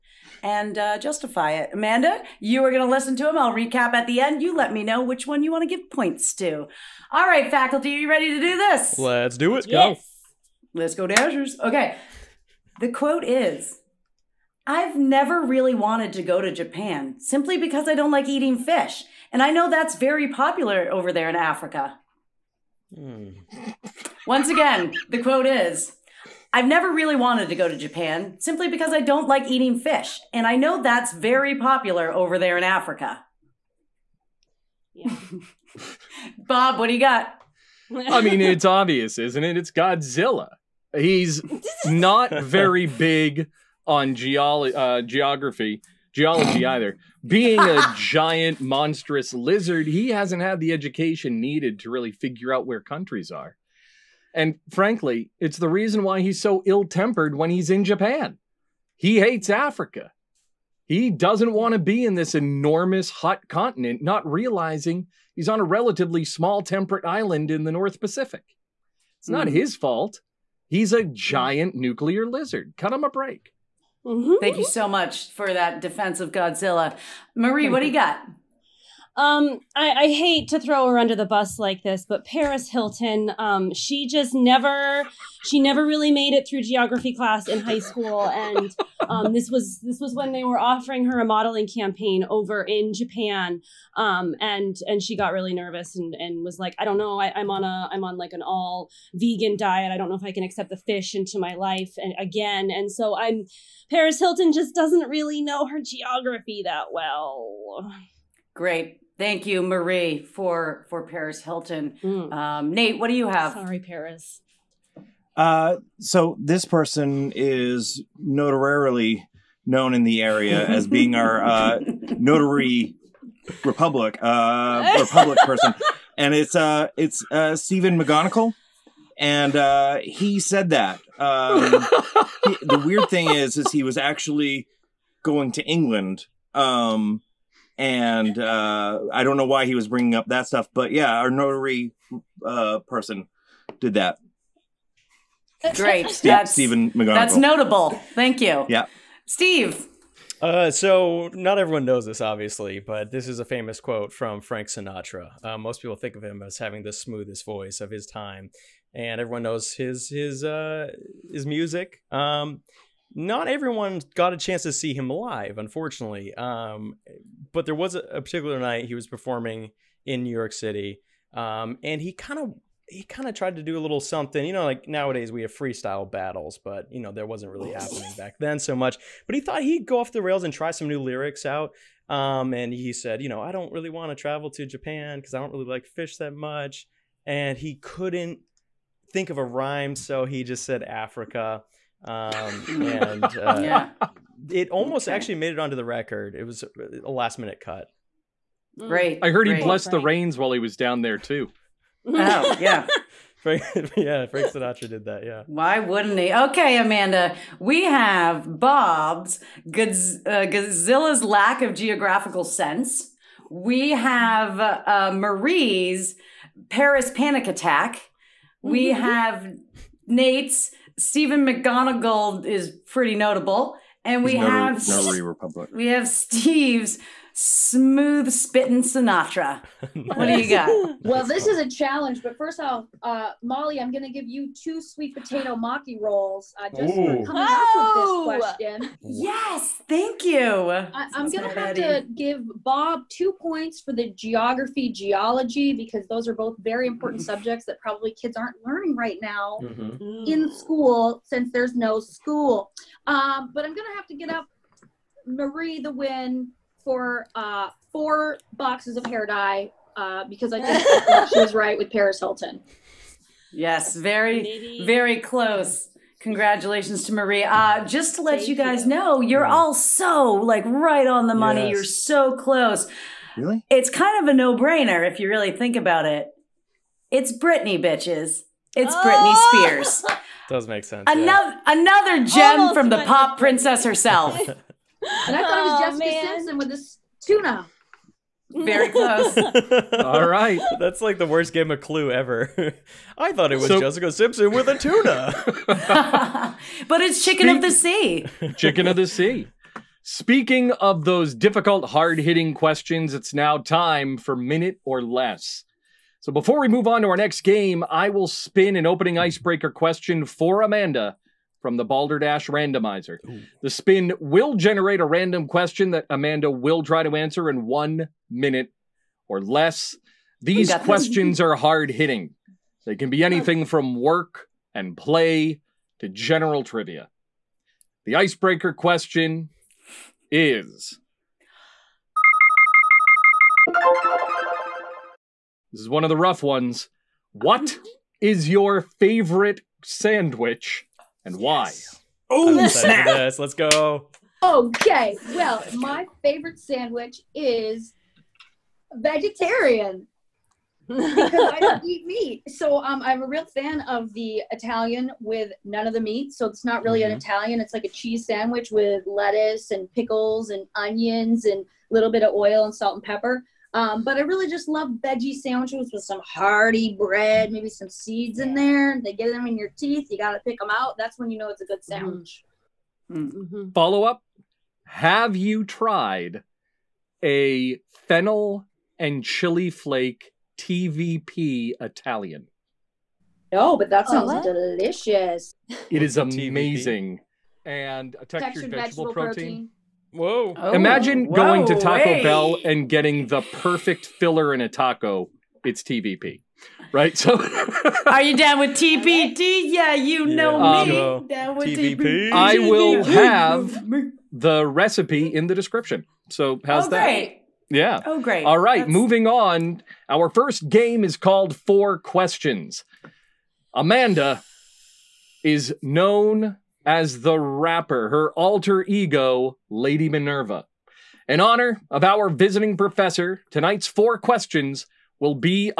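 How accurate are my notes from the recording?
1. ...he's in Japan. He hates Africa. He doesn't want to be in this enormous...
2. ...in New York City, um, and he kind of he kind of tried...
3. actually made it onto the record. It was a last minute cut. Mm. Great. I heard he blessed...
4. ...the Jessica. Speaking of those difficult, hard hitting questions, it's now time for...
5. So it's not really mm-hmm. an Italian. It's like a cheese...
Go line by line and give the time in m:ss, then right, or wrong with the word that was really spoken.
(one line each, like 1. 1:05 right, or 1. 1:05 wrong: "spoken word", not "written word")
1. 0:57 right
2. 2:50 right
3. 3:15 right
4. 4:58 wrong: "Sea", not "Jessica"
5. 5:56 right.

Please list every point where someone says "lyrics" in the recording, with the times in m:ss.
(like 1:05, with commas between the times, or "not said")
3:01.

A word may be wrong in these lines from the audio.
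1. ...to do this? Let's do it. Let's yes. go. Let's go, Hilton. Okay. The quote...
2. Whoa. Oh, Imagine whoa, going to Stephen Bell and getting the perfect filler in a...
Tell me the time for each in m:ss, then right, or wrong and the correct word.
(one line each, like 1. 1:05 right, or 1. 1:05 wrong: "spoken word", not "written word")
1. 0:08 wrong: "Dashers", not "Hilton"
2. 6:30 wrong: "Taco", not "Stephen".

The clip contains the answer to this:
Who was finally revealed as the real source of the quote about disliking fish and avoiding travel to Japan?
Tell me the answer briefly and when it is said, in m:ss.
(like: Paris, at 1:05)
Britney Spears, at 4:39.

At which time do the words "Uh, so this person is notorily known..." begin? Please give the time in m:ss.
1:55.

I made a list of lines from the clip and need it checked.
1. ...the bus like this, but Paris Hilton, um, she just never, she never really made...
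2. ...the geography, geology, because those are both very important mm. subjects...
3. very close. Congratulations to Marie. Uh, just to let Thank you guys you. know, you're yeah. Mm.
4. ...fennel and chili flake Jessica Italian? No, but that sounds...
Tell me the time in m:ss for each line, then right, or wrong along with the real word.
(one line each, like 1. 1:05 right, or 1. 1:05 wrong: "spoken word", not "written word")
1. 1:21 right
2. 4:03 right
3. 4:24 right
4. 6:18 wrong: "TVP", not "Jessica".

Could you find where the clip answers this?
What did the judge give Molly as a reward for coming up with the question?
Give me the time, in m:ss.
3:54.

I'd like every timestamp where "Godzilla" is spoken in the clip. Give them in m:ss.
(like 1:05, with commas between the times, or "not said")
0:39, 1:16, 3:29.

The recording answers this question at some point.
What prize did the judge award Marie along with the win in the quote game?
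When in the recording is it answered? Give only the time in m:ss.
4:17.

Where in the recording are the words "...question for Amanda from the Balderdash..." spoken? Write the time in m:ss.
5:09.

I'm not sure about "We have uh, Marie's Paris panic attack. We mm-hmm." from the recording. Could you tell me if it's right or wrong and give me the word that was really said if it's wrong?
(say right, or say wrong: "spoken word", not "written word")
right.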